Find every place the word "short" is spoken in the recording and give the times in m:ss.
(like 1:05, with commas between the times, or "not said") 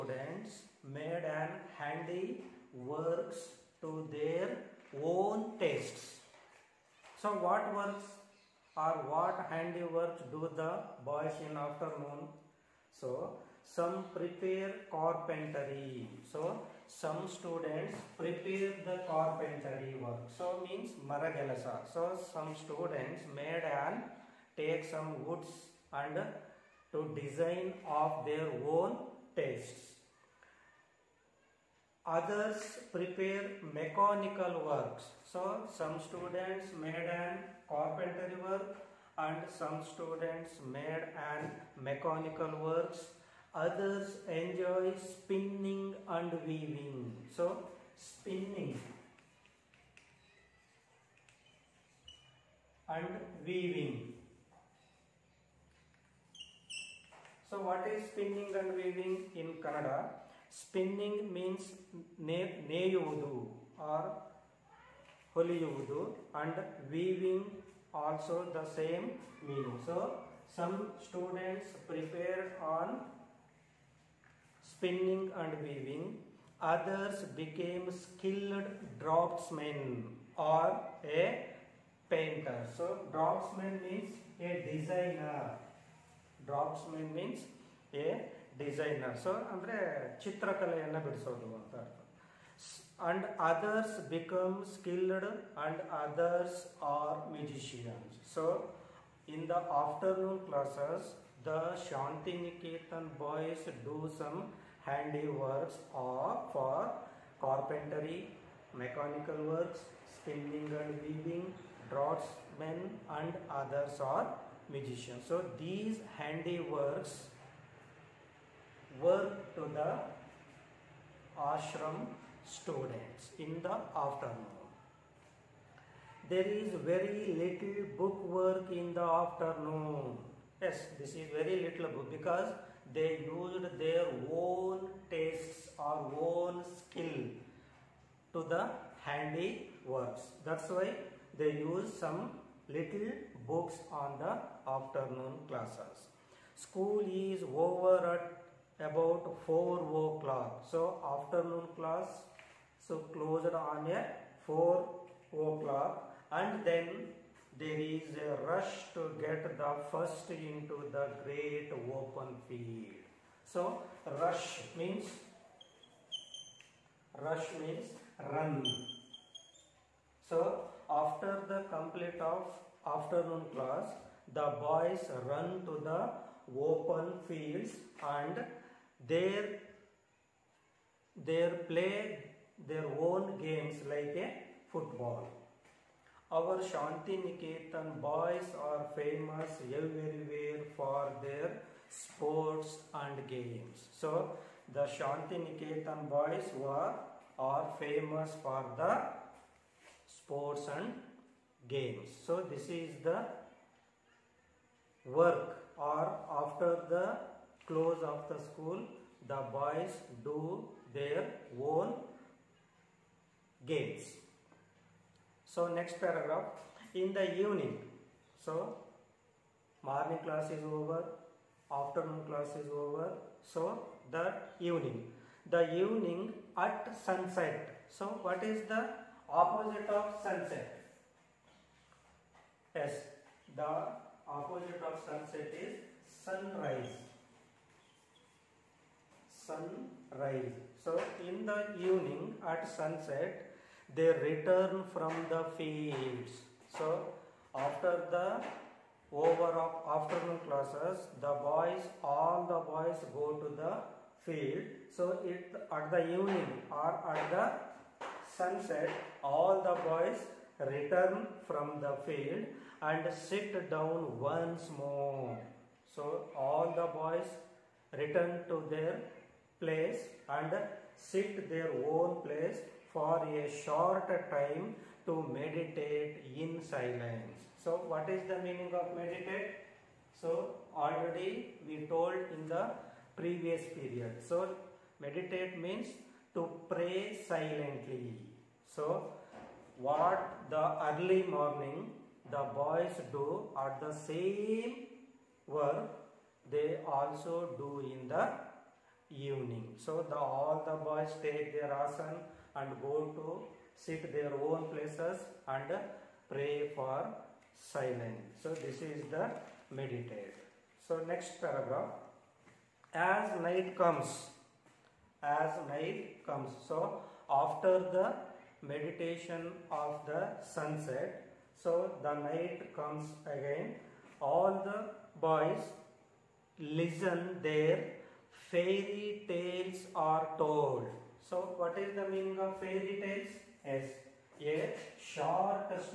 4:33, 5:35.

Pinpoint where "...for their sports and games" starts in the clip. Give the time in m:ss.
3:10.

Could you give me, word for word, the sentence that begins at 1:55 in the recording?
So these handiworks work to the ashram students in the afternoon.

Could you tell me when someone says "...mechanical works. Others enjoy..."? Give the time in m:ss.
0:41.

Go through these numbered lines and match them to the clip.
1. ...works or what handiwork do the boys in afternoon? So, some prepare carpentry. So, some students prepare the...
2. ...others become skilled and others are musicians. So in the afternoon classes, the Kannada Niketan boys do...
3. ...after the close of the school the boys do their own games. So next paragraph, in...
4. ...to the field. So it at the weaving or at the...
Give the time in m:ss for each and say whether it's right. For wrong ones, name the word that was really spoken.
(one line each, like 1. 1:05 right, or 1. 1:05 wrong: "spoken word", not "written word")
1. 0:07 right
2. 1:33 wrong: "Shanti", not "Kannada"
3. 3:26 right
4. 4:13 wrong: "evening", not "weaving".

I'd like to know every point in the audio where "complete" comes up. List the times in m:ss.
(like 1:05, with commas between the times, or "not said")
2:51.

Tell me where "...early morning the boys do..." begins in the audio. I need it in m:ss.
4:50.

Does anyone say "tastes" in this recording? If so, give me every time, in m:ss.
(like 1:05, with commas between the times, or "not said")
0:05, 0:29, 2:15.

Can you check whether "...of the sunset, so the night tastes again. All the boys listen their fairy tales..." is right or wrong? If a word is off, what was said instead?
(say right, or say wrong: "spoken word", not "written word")
wrong: "comes", not "tastes".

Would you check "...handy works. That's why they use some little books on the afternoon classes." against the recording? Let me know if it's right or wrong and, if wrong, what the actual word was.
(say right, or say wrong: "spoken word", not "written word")
right.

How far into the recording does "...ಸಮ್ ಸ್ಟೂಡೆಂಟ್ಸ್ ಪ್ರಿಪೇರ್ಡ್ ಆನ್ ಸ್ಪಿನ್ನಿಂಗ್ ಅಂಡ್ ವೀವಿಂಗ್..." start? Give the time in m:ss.
1:10.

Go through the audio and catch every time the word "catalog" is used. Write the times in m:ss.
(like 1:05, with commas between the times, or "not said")
not said.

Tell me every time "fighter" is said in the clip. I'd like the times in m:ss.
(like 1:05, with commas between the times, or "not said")
not said.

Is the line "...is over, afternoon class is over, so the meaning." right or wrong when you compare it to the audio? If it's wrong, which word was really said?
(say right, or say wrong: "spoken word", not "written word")
wrong: "evening", not "meaning".